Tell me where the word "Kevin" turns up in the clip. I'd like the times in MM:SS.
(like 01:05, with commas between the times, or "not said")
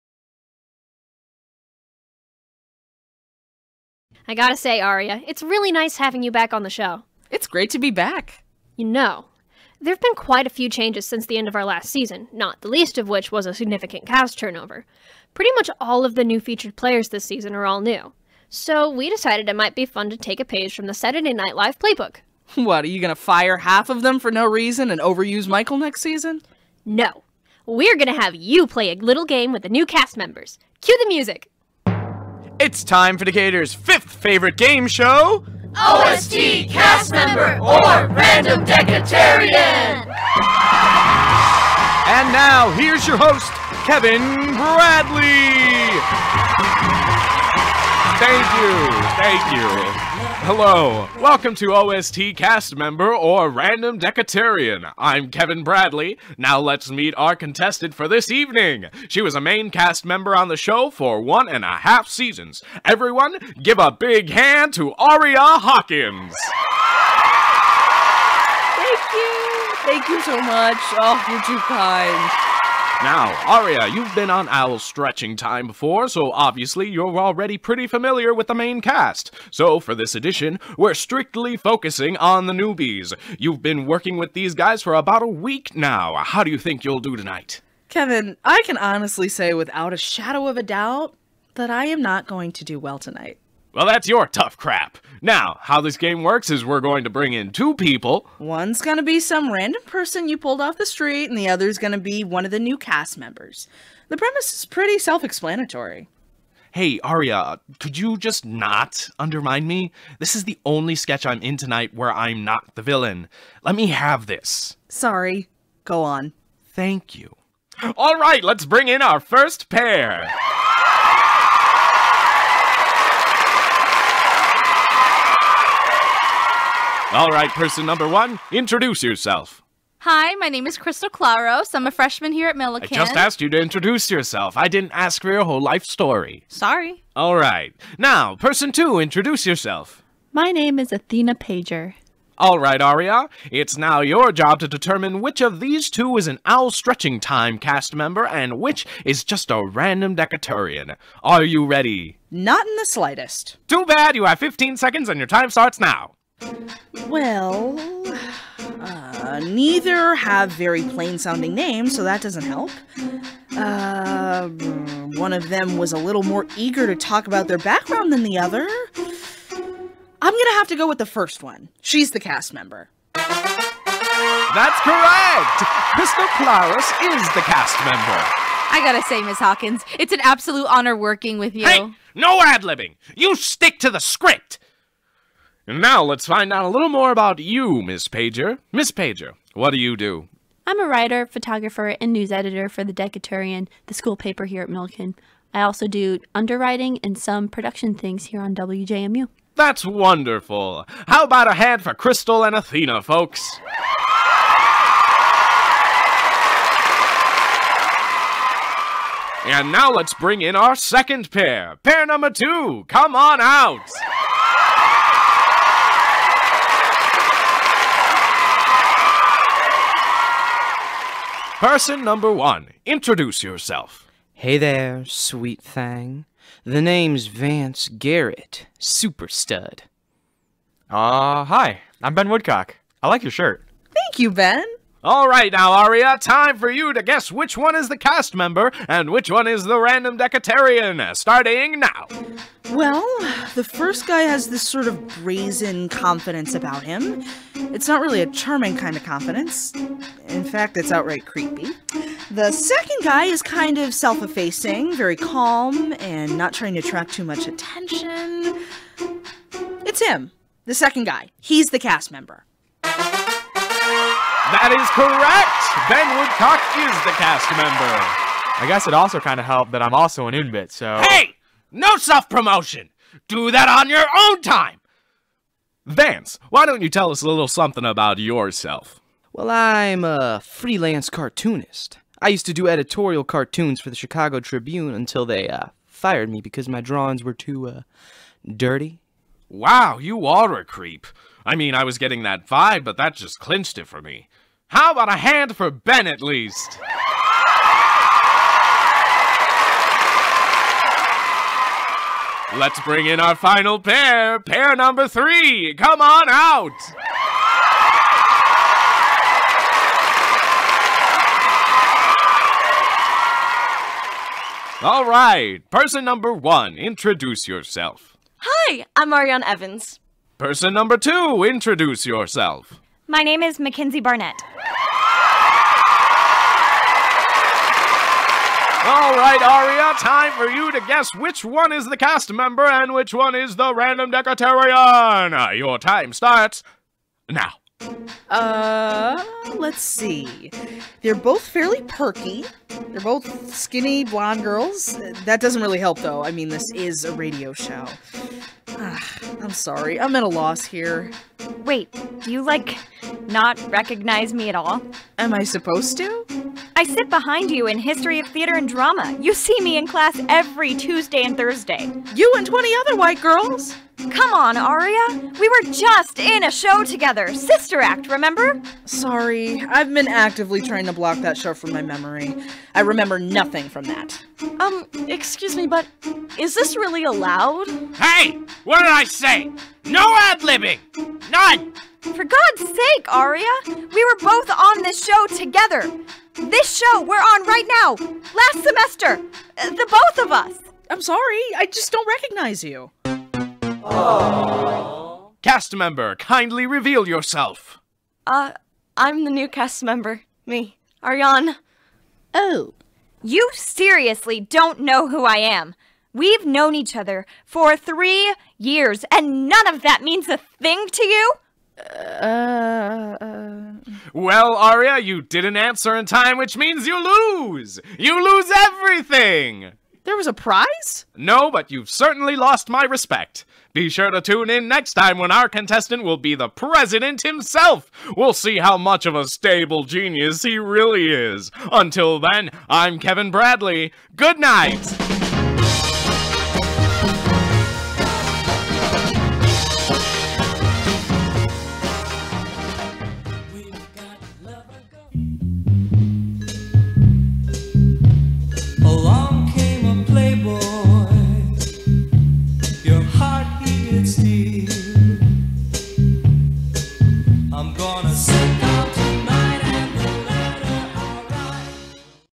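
00:43, 00:55, 01:27, 07:12.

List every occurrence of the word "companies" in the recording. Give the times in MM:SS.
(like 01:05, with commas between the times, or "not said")
not said.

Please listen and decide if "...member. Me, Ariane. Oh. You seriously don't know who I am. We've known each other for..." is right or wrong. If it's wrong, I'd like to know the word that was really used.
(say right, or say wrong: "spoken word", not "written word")
right.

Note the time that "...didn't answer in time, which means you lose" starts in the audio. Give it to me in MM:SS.
06:55.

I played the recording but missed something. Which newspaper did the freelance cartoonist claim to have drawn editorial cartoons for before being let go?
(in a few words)
Chicago Tribune.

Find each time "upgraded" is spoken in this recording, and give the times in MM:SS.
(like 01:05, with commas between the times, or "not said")
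not said.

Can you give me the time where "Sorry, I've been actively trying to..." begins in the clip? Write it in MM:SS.
06:08.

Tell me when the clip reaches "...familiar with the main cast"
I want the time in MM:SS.
01:17.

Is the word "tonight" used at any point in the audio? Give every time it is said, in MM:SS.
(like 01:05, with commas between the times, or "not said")
01:27, 01:32, 01:51.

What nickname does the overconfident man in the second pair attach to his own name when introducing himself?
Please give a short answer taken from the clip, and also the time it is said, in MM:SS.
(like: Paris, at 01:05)
super stud, at 03:48.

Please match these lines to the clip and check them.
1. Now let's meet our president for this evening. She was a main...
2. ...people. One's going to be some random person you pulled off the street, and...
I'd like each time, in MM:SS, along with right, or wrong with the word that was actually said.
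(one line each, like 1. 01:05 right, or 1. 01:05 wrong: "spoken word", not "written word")
1. 00:56 wrong: "contestant", not "president"
2. 01:37 right.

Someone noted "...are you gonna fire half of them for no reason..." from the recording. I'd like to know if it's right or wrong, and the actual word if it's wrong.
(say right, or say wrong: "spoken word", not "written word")
right.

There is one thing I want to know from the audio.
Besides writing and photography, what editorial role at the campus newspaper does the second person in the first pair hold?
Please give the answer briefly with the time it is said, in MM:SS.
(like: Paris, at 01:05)
news editor, at 03:12.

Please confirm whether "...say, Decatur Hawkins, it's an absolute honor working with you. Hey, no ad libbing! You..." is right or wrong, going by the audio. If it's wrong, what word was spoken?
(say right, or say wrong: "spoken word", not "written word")
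wrong: "Miss", not "Decatur".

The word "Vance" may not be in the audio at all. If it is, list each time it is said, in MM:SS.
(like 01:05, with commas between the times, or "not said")
03:47, 04:35.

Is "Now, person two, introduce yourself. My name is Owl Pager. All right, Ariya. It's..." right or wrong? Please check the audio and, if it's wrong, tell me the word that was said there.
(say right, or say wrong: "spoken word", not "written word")
wrong: "Athena", not "Owl".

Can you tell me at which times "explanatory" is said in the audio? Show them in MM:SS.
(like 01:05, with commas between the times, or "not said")
01:45.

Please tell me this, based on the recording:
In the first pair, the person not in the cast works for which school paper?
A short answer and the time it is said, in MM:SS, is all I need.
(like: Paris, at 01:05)
the Decaturian, at 03:12.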